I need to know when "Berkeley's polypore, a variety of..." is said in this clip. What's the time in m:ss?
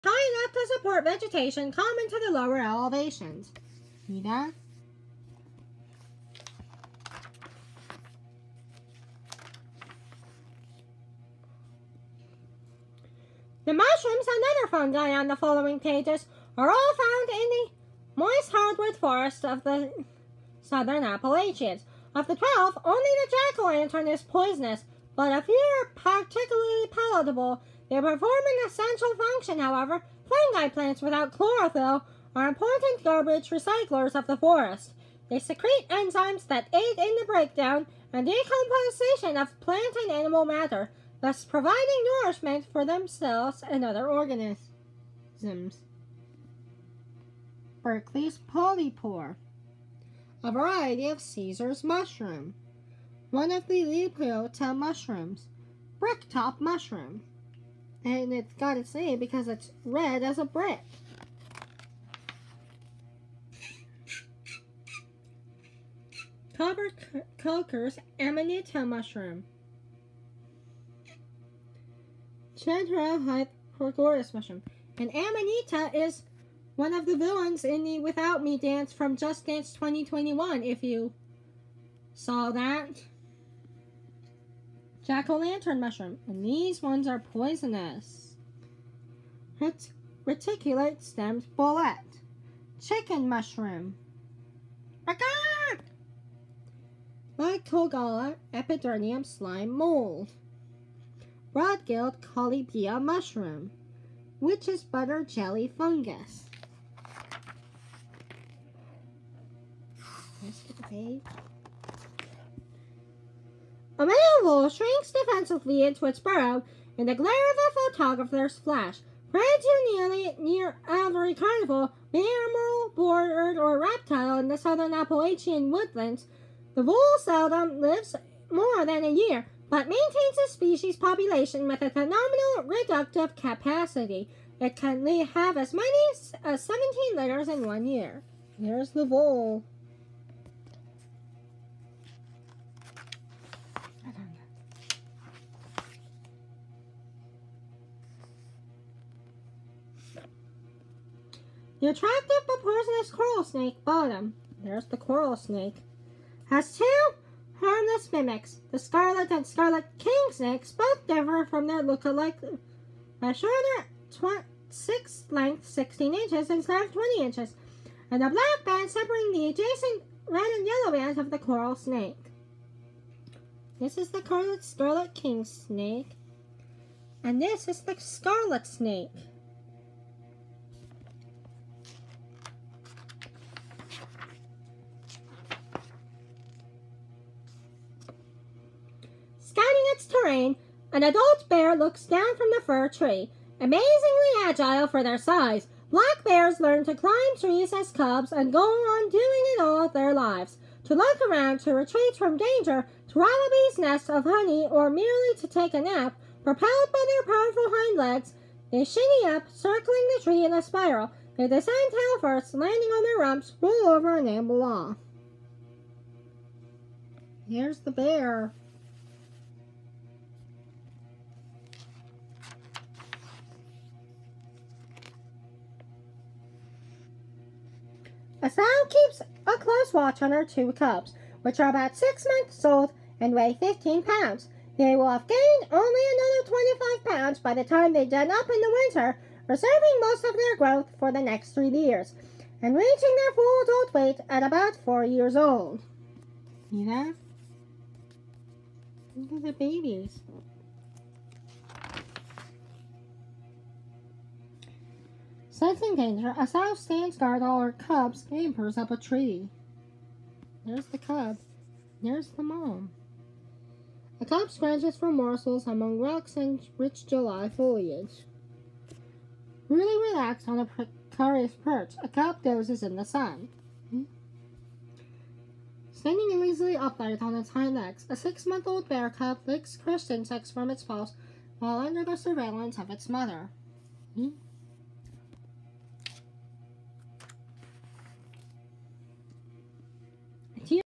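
0:47.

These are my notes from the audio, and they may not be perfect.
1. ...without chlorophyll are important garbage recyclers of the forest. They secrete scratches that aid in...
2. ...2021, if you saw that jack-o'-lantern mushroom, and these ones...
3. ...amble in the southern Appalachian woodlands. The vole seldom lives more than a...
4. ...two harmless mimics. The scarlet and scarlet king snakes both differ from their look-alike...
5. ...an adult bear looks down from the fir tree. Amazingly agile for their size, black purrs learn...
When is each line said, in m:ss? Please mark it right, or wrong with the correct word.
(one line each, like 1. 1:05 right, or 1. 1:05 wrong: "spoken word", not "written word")
1. 0:31 wrong: "enzymes", not "scratches"
2. 1:19 right
3. 2:03 wrong: "reptile", not "amble"
4. 2:36 right
5. 3:10 wrong: "bears", not "purrs".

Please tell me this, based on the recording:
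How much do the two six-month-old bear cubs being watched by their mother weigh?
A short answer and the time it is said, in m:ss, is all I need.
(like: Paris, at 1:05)
15 pounds, at 3:53.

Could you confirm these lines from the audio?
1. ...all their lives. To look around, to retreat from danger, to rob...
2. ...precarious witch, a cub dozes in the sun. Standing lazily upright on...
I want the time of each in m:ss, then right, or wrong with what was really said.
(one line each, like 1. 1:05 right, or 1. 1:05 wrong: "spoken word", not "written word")
1. 3:19 right
2. 4:30 wrong: "perch", not "witch".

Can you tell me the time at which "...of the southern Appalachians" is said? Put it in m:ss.
0:19.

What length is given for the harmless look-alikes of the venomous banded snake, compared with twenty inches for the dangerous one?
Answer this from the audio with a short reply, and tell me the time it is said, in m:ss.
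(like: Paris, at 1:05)
16 inches, at 2:45.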